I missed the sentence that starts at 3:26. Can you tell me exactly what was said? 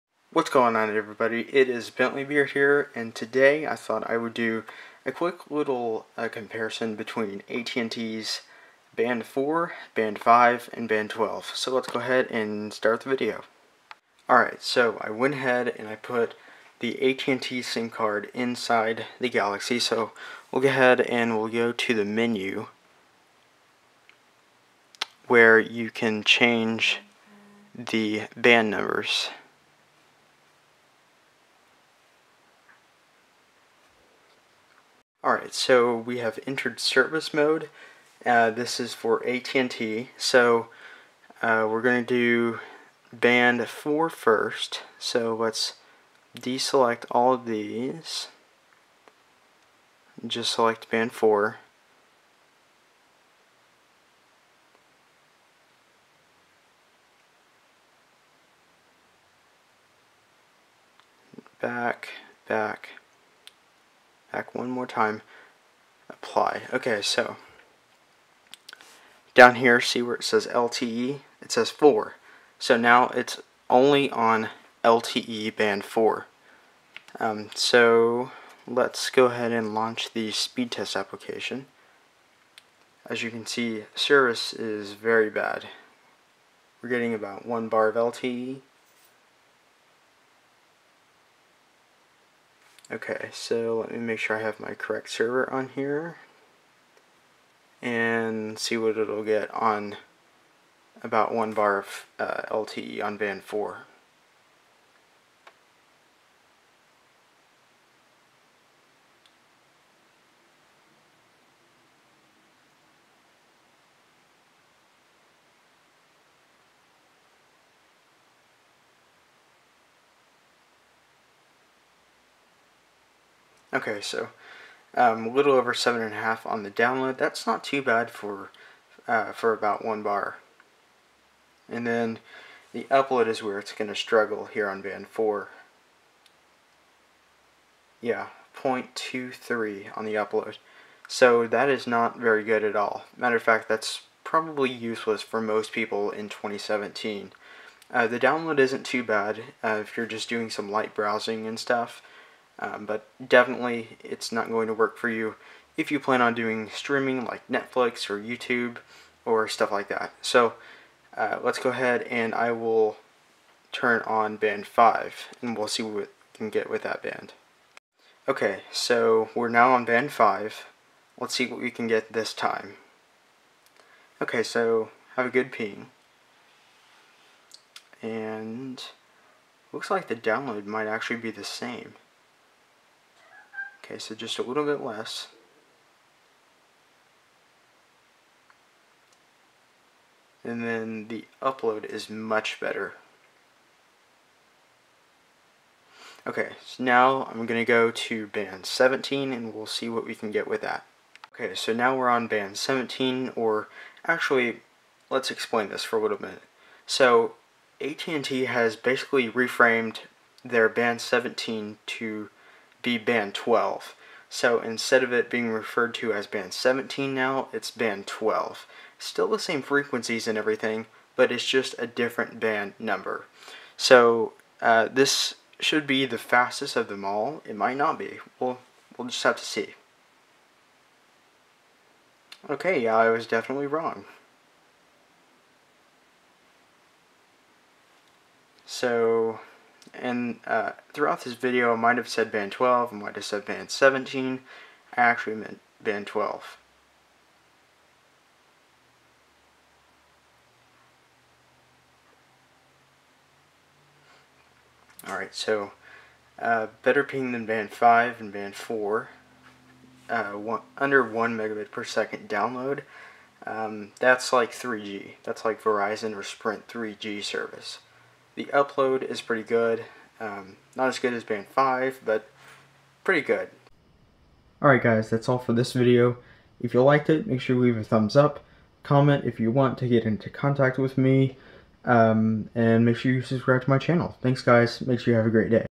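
So AT&T has basically reframed their band 17 to be band 12.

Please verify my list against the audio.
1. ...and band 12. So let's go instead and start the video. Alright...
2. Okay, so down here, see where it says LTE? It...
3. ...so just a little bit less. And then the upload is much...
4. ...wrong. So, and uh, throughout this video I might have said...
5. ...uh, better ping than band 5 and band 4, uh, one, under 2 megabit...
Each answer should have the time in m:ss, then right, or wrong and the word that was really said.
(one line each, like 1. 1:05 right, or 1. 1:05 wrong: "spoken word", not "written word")
1. 0:10 wrong: "ahead", not "instead"
2. 1:06 right
3. 3:03 right
4. 3:53 right
5. 4:16 wrong: "1", not "2".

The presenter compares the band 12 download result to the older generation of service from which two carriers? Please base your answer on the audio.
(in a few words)
Verizon or Sprint.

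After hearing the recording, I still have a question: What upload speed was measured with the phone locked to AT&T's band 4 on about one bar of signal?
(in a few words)
0.23.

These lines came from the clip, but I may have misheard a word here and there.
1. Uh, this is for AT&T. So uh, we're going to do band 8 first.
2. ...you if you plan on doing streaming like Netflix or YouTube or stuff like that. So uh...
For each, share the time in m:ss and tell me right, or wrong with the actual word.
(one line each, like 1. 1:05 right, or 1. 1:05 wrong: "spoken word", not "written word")
1. 0:38 wrong: "4", not "8"
2. 2:35 right.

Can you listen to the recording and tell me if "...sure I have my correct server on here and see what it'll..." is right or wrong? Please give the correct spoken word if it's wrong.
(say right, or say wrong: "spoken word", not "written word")
right.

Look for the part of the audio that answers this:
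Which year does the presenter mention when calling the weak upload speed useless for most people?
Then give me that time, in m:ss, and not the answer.
2:26.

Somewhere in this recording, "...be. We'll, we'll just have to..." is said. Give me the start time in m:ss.
3:47.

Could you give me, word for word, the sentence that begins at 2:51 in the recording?
Let's see what we can get this time.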